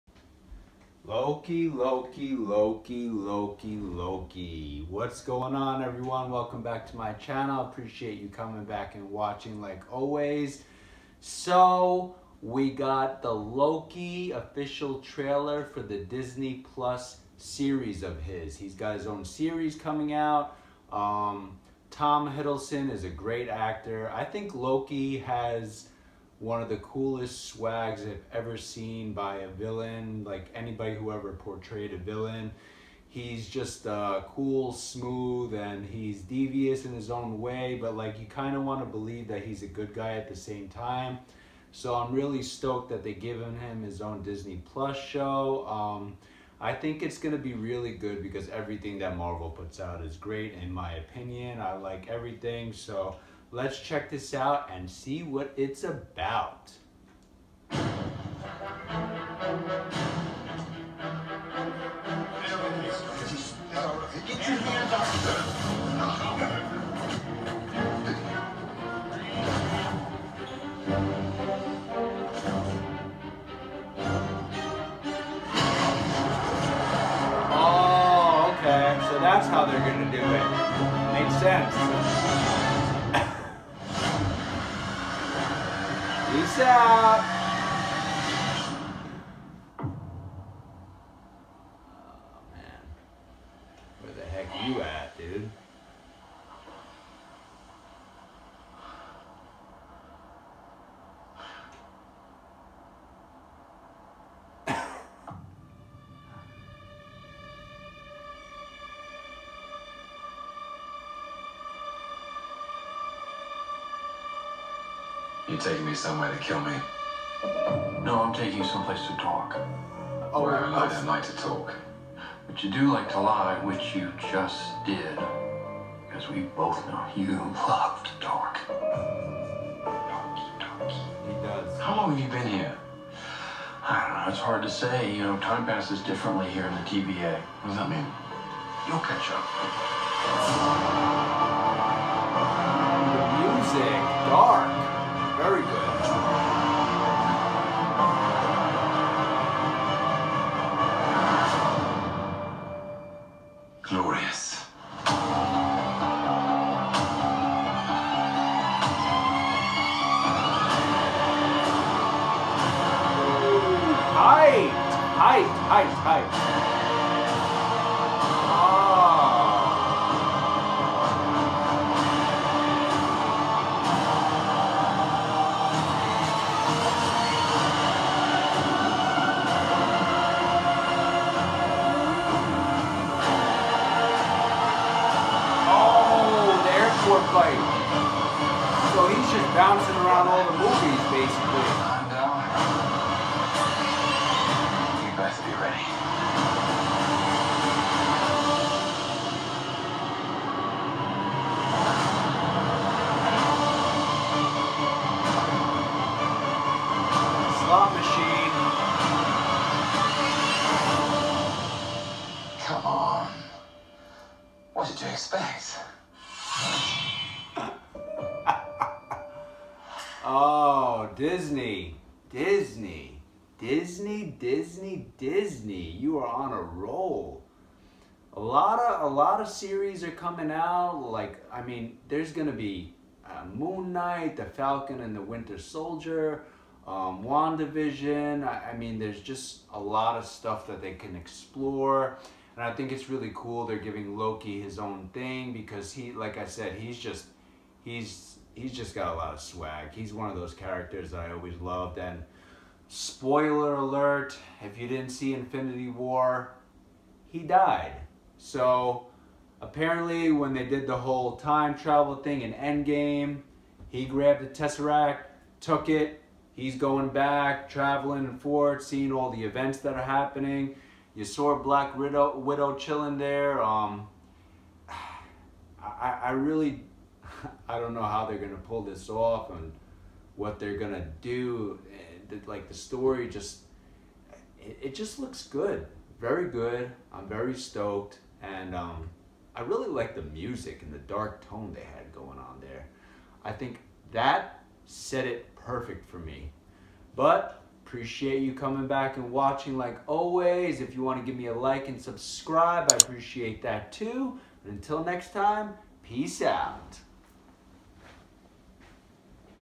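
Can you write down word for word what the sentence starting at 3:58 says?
I, I mean, there's just a lot of stuff that they can explore.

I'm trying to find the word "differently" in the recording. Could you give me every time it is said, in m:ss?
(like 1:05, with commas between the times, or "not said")
2:15.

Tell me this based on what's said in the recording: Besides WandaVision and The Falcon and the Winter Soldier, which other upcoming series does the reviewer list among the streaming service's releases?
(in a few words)
Moon Knight.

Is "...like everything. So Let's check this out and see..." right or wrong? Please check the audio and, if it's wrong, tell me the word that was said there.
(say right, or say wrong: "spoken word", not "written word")
right.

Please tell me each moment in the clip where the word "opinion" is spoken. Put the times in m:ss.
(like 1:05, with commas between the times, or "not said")
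0:50.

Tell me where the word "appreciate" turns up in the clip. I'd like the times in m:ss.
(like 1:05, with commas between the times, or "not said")
0:07, 4:57, 5:02.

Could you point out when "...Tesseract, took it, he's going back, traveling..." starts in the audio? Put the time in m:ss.
4:24.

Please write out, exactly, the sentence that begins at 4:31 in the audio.
You saw Black Widow, Widow chilling there.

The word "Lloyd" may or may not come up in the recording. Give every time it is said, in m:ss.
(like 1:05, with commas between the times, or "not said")
3:07.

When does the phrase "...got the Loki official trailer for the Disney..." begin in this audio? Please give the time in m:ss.
0:12.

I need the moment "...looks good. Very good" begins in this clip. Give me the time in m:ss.
4:45.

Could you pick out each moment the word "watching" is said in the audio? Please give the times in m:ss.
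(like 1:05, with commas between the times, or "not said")
0:09, 4:59.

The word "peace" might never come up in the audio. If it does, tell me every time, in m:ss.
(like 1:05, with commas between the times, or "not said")
1:26, 5:06.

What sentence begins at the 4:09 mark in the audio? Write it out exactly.
He's one of those characters that I always loved.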